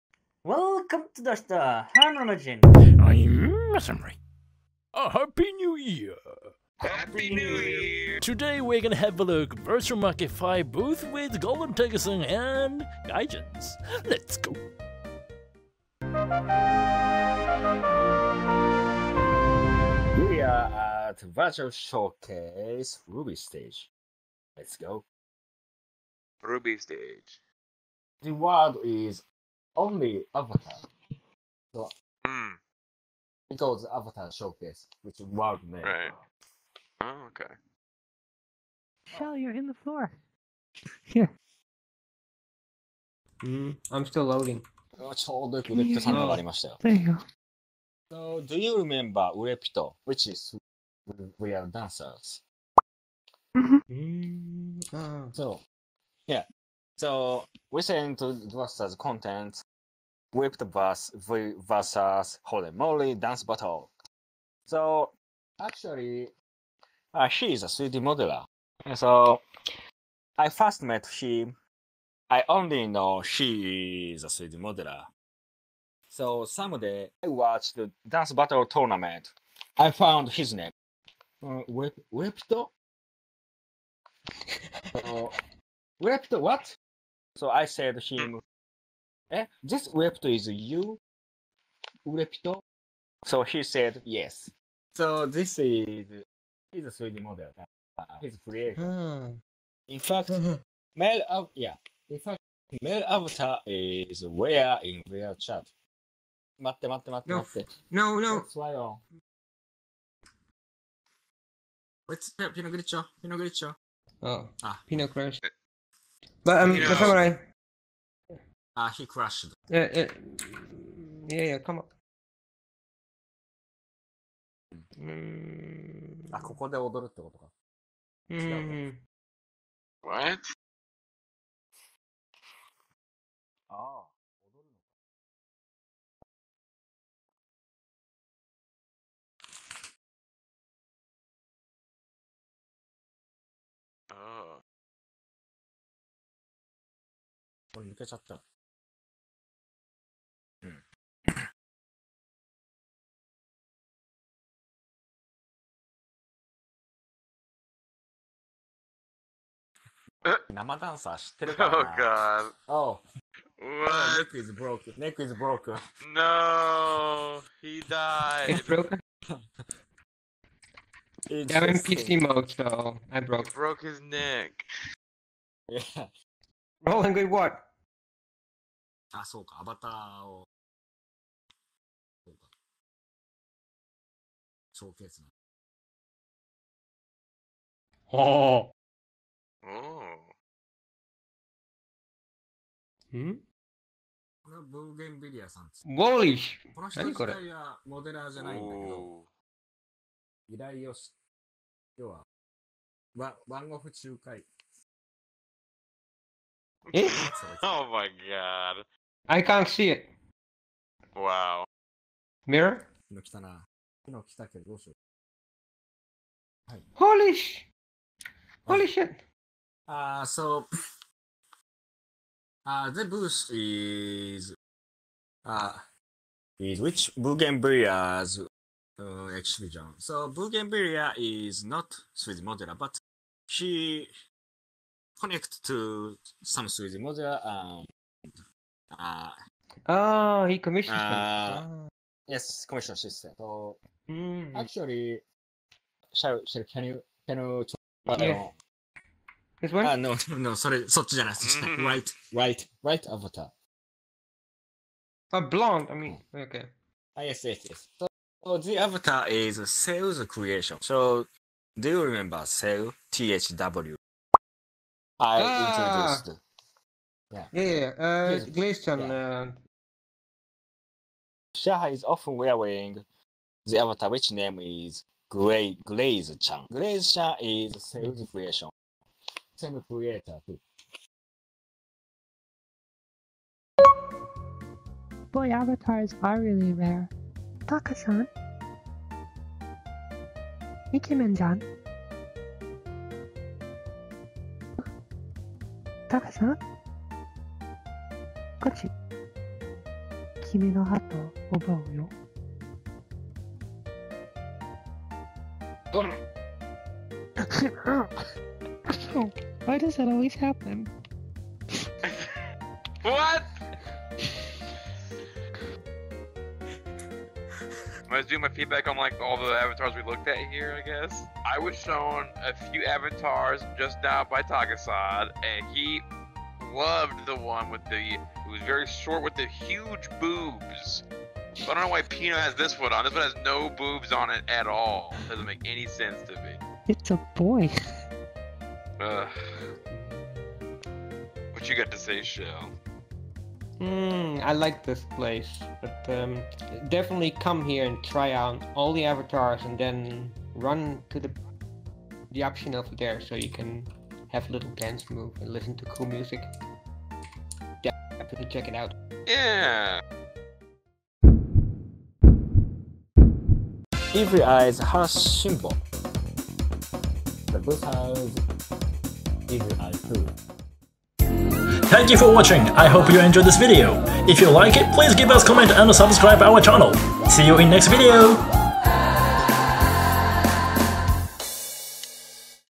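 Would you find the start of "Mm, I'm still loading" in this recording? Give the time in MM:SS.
00:43.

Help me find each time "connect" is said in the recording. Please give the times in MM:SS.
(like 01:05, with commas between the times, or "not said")
03:55.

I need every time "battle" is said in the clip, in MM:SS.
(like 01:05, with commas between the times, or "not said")
01:03, 01:18.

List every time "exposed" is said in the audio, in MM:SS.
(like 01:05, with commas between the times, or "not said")
not said.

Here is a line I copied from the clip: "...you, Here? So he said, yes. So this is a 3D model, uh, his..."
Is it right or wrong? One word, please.
wrong.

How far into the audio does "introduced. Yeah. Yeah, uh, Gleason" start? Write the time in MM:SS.
04:26.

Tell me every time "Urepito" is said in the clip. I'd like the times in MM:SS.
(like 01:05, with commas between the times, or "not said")
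00:49, 01:32.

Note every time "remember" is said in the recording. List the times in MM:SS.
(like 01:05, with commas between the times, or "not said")
00:48, 04:22.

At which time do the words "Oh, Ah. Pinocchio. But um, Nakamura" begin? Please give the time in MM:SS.
01:54.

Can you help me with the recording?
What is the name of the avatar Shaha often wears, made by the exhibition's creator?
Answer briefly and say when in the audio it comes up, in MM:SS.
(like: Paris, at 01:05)
Gray Glaze Chan, at 04:35.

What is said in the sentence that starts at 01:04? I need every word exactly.
So actually, uh, she is a 3D modeler.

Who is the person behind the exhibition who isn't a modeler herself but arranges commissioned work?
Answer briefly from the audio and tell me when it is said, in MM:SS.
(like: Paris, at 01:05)
Bougainvillea, at 03:50.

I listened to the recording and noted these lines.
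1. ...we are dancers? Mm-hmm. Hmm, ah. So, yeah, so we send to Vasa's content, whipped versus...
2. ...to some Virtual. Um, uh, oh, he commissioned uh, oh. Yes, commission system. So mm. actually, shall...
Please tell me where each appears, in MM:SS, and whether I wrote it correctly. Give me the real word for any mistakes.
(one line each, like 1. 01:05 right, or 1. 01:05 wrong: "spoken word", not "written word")
1. 00:51 right
2. 03:55 wrong: "Sujimoto", not "Virtual".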